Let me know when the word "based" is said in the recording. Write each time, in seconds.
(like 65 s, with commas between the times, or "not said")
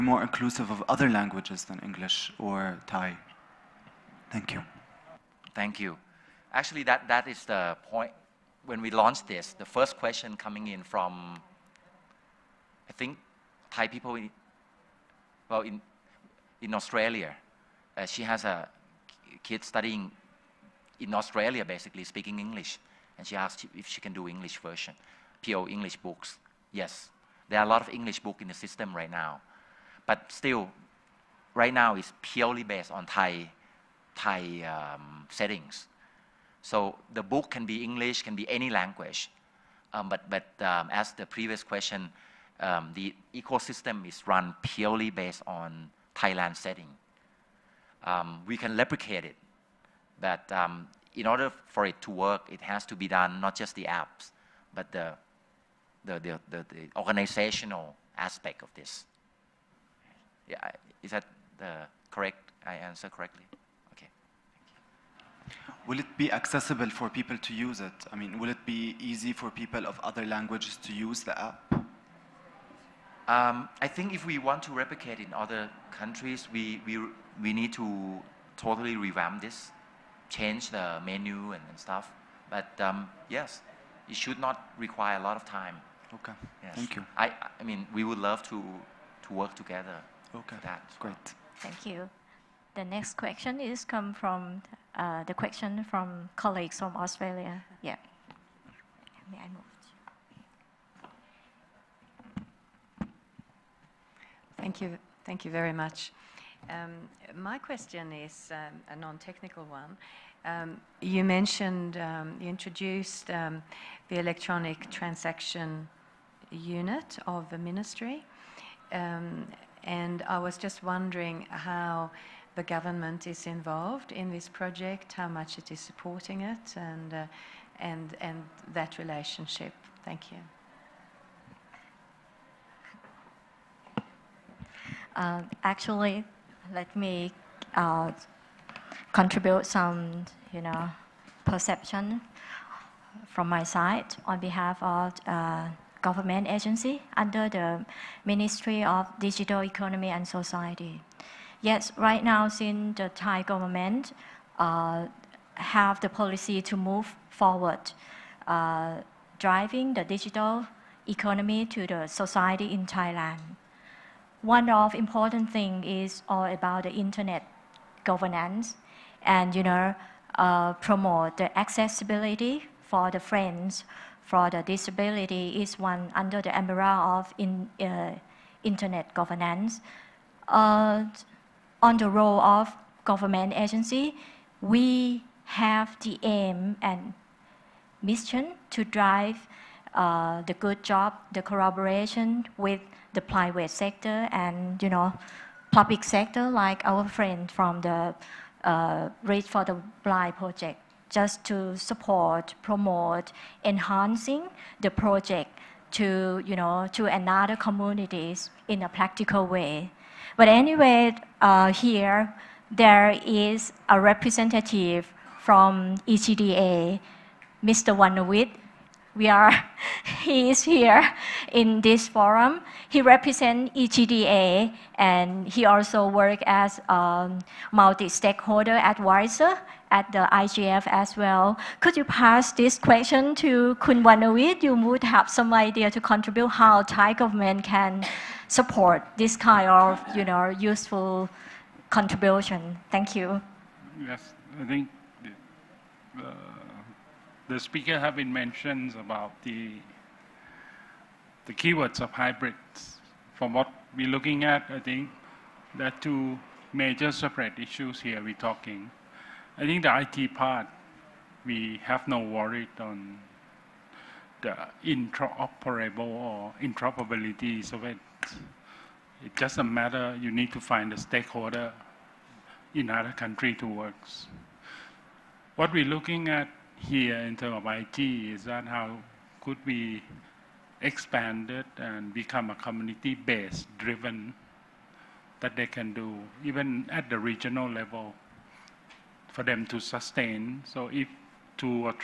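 32 s, 45 s, 282 s.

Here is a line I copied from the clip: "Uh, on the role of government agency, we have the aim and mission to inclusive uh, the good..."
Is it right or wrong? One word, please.
wrong.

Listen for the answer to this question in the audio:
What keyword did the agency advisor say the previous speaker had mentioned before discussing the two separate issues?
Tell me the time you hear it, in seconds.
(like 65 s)
252 s.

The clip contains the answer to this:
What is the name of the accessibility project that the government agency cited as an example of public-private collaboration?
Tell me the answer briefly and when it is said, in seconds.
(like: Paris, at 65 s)
Read for the Blind, at 199 s.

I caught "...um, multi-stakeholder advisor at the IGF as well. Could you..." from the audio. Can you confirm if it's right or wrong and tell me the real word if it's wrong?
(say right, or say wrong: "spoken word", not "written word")
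right.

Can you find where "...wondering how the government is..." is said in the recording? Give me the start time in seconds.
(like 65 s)
120 s.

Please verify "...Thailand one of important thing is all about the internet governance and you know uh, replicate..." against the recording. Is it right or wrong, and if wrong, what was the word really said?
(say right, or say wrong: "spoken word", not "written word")
wrong: "promote", not "replicate".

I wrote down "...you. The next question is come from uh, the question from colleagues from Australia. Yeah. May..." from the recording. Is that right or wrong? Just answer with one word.
right.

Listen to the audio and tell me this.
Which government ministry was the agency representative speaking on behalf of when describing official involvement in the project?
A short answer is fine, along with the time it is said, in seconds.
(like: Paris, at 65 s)
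Ministry of Digital Economy and Society, at 148 s.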